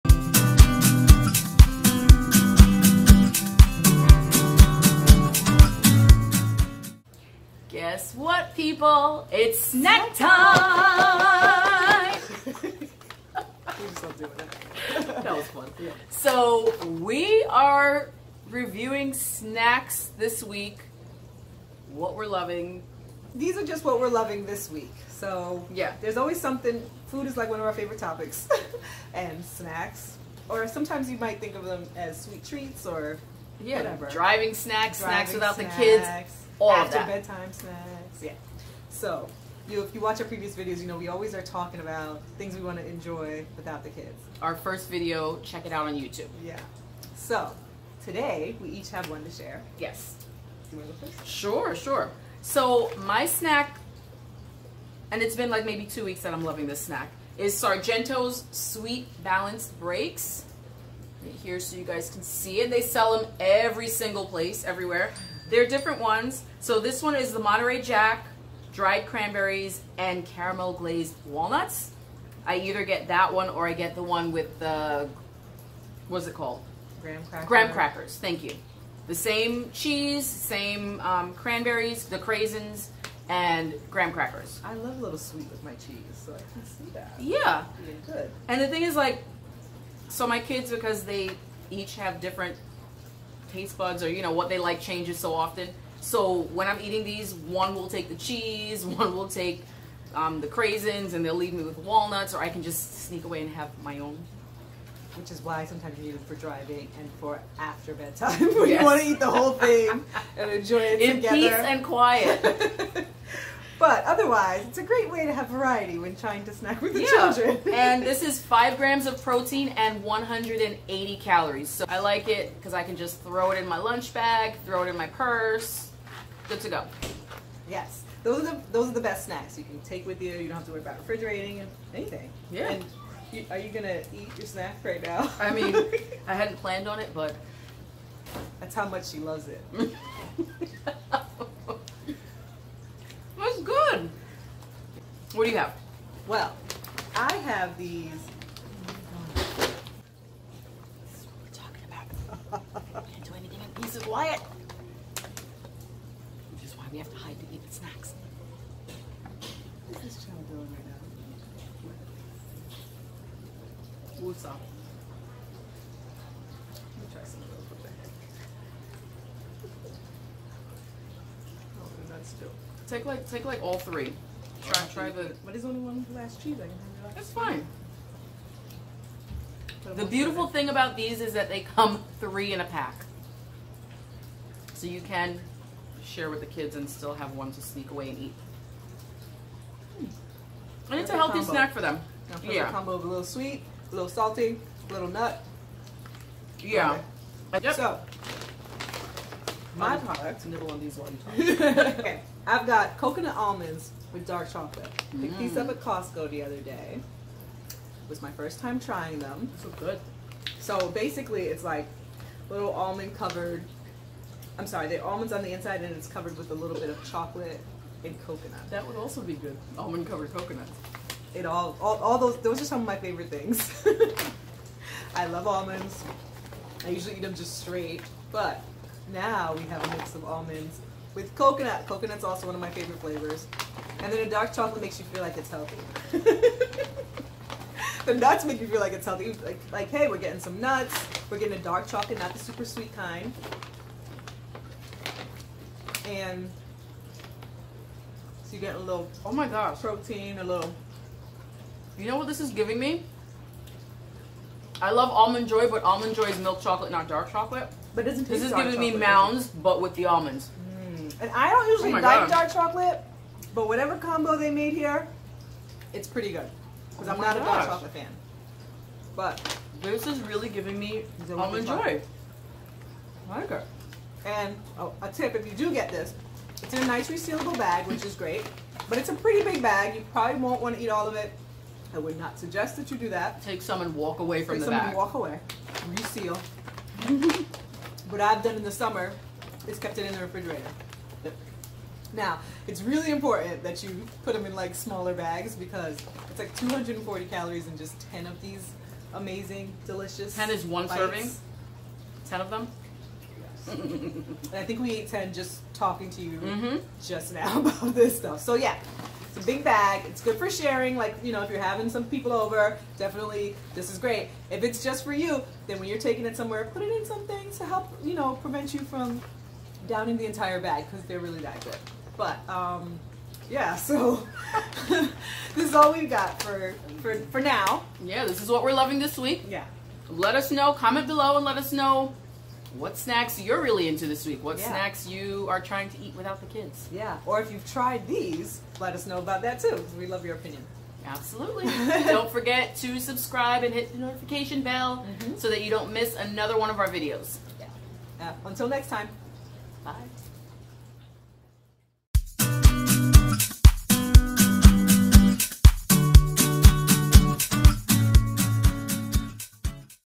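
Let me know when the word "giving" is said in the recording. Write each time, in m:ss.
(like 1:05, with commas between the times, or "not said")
4:12, 4:18, 4:30.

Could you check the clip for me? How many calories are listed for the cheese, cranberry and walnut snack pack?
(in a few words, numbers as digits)
180.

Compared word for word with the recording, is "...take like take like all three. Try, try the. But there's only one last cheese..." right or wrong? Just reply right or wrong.
right.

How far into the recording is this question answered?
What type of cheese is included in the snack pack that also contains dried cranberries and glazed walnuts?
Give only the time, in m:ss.
1:07.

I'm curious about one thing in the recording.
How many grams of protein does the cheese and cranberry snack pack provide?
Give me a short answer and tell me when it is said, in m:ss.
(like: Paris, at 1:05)
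5 grams, at 1:58.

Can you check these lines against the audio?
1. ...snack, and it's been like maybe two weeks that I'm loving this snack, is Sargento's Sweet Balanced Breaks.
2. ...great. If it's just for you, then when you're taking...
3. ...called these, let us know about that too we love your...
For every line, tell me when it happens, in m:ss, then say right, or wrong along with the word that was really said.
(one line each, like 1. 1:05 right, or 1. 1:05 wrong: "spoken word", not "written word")
1. 0:53 right
2. 5:13 right
3. 5:37 wrong: "tried", not "called".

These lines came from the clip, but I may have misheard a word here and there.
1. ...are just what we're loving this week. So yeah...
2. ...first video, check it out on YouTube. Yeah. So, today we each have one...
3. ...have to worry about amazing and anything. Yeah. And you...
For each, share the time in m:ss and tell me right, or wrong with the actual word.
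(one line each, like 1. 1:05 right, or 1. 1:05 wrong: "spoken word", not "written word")
1. 0:23 right
2. 0:44 right
3. 2:10 wrong: "refrigerating", not "amazing".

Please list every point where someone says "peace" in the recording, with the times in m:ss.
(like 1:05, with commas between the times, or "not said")
1:51, 2:33.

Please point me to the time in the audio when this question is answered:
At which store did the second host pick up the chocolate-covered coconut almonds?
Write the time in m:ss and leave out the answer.
3:25.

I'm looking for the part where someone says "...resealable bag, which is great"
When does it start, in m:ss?
4:37.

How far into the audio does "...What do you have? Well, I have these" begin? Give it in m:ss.
2:25.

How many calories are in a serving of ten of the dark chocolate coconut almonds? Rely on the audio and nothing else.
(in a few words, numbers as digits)
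240.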